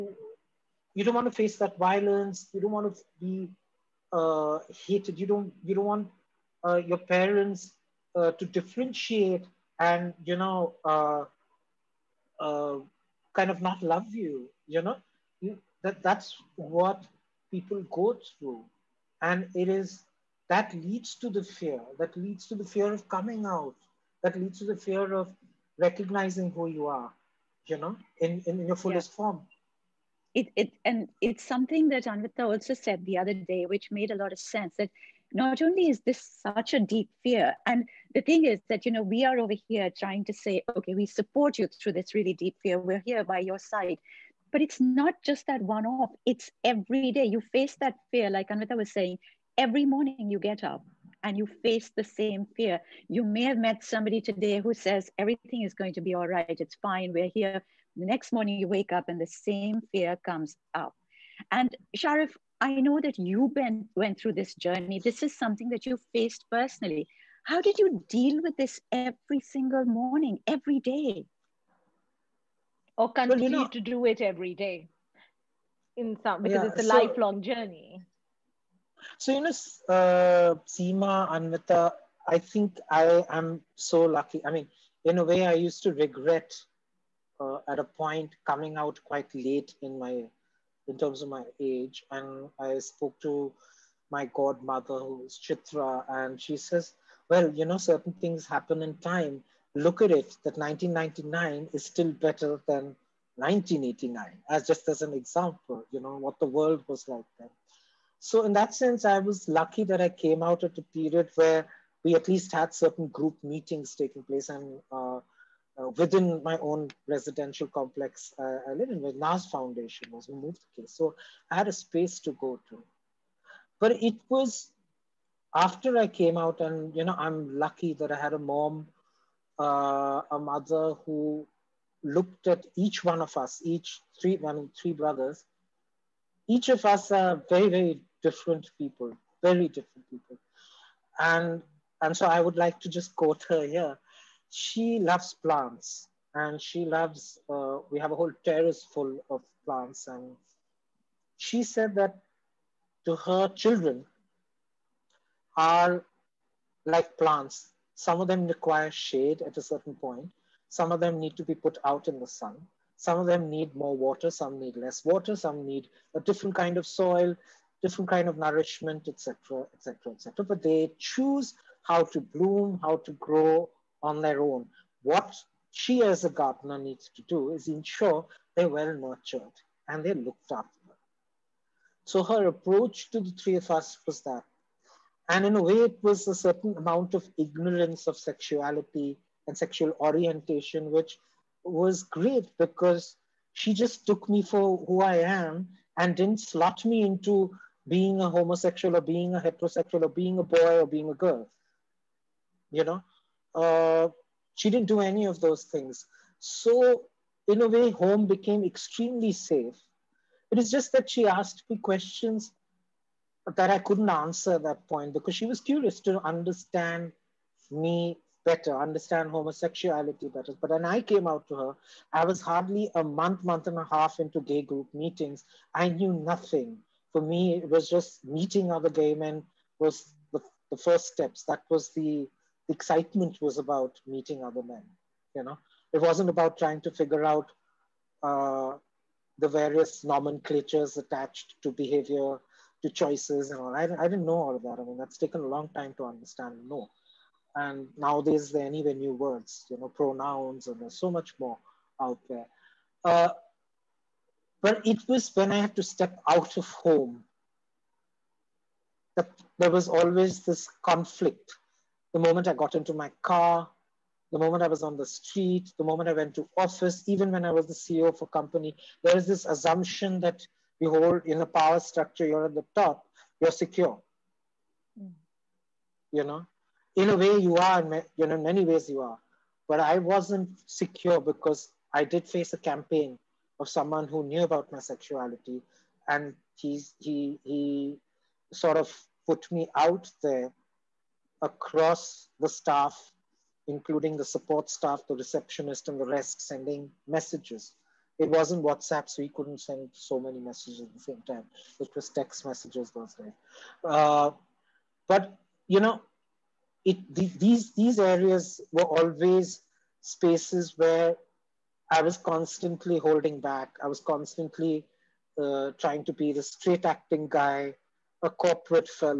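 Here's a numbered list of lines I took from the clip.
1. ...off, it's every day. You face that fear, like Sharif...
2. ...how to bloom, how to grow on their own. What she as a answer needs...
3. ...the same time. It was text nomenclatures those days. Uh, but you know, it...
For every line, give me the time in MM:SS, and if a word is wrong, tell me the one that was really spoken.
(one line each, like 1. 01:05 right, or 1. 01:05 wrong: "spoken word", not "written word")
1. 00:45 wrong: "Anvita", not "Sharif"
2. 02:51 wrong: "gardener", not "answer"
3. 05:00 wrong: "messages", not "nomenclatures".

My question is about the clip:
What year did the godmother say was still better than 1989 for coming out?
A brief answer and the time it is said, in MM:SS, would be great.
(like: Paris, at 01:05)
1999, at 01:40.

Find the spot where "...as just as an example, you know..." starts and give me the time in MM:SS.
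01:44.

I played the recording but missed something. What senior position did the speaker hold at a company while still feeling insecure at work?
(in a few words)
CEO.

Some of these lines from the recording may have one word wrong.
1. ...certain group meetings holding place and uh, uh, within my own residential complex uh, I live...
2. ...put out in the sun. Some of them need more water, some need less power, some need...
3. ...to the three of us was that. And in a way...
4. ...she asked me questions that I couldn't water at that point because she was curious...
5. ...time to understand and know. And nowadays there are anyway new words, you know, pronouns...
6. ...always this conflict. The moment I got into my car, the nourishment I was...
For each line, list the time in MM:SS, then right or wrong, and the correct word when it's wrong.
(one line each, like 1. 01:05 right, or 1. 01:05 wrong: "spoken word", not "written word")
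1. 01:52 wrong: "taking", not "holding"
2. 02:41 wrong: "water", not "power"
3. 03:03 right
4. 03:31 wrong: "answer", not "water"
5. 04:05 right
6. 04:19 wrong: "moment", not "nourishment".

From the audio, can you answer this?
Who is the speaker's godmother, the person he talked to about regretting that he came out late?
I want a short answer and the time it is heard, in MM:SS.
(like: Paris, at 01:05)
Chitra, at 01:35.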